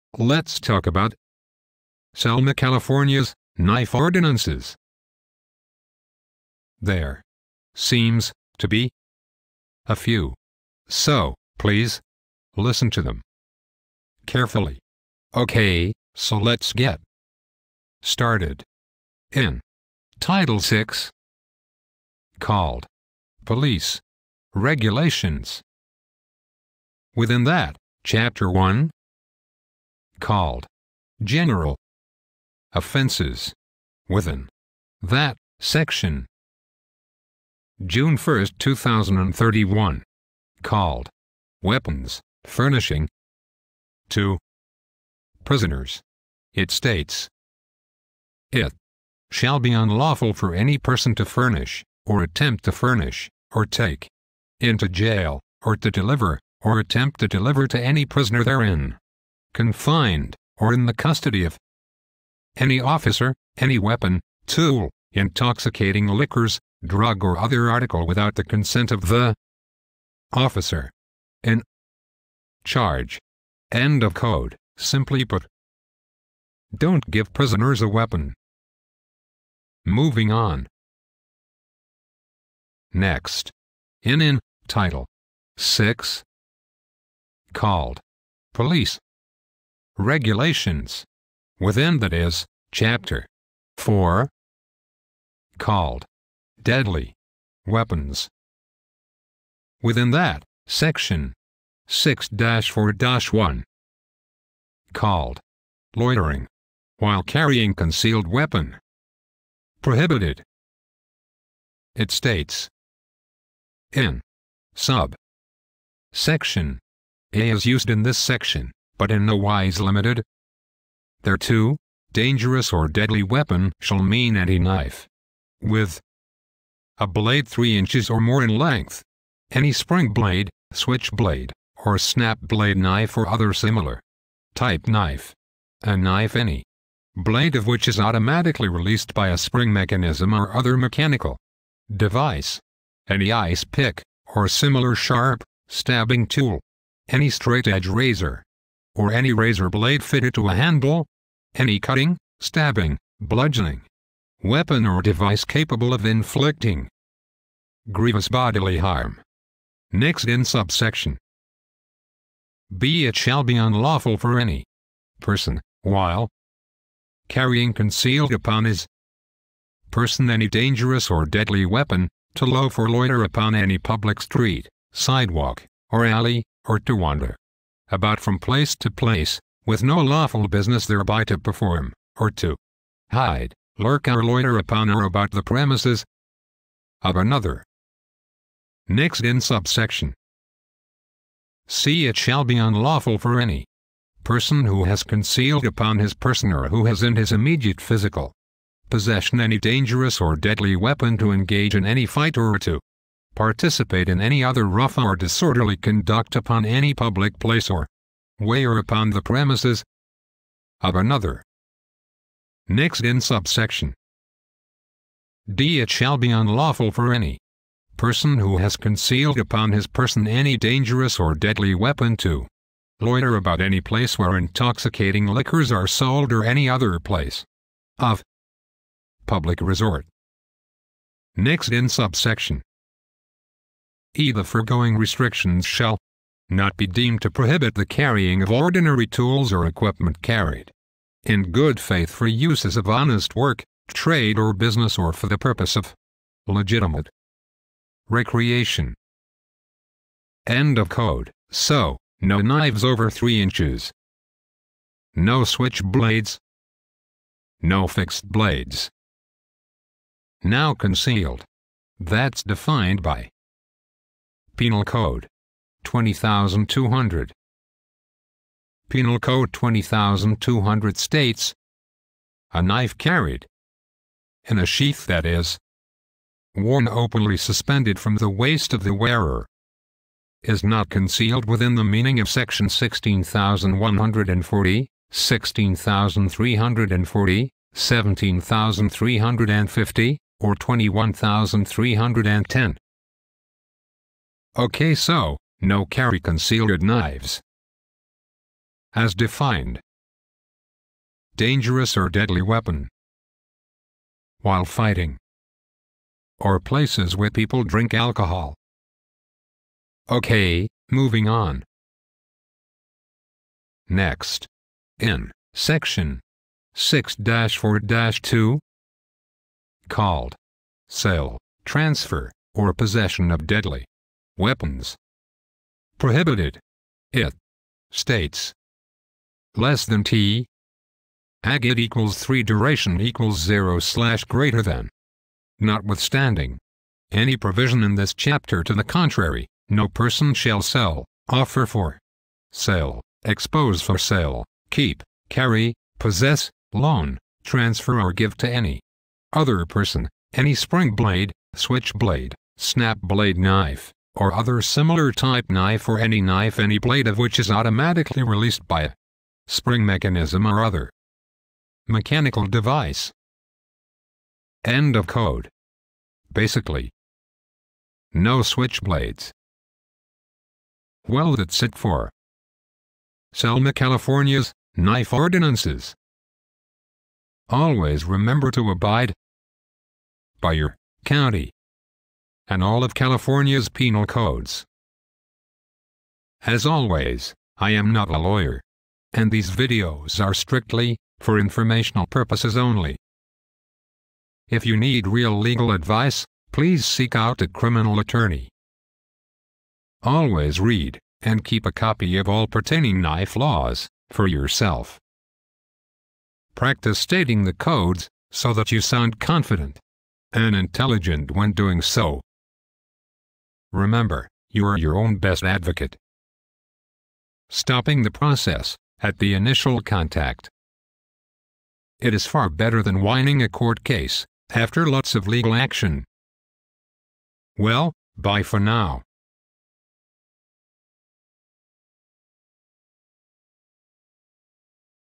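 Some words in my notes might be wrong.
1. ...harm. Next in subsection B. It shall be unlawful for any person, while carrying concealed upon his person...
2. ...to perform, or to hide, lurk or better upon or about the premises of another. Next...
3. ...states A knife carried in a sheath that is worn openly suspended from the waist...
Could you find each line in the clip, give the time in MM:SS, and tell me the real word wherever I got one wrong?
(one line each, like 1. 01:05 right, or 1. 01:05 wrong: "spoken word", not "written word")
1. 02:38 right
2. 03:01 wrong: "loiter", not "better"
3. 04:30 right.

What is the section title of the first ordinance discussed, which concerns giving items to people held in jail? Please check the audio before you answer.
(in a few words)
Weapons furnishing to prisoners.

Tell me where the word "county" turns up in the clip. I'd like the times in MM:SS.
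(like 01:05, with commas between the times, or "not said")
06:21.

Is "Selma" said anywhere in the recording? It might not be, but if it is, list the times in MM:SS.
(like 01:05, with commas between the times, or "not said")
00:02, 06:13.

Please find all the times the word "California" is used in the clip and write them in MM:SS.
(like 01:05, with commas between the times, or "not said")
00:02, 06:13, 06:22.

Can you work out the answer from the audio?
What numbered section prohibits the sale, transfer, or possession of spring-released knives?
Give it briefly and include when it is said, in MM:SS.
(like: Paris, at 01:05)
6-4-2, at 05:16.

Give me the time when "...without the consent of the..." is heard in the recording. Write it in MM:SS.
01:08.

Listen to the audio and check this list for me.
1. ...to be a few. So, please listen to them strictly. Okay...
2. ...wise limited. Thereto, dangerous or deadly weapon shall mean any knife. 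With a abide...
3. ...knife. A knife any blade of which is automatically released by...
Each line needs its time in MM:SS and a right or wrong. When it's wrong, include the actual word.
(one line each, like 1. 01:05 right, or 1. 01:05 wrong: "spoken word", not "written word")
1. 00:08 wrong: "carefully", not "strictly"
2. 01:59 wrong: "blade", not "abide"
3. 02:14 right.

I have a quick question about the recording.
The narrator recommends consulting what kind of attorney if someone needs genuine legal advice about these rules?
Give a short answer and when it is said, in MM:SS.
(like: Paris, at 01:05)
Criminal attorney, at 06:37.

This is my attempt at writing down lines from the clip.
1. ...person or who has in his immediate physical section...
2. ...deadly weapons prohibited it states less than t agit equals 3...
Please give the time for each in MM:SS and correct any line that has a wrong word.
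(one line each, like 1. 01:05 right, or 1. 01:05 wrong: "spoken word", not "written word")
1. 03:16 wrong: "possession", not "section"
2. 05:23 right.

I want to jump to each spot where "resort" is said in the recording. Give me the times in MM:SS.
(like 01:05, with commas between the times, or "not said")
03:49.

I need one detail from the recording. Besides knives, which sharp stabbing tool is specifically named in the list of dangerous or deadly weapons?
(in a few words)
Ice pick.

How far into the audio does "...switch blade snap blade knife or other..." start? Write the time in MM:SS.
05:51.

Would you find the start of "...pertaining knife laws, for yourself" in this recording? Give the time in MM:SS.
06:42.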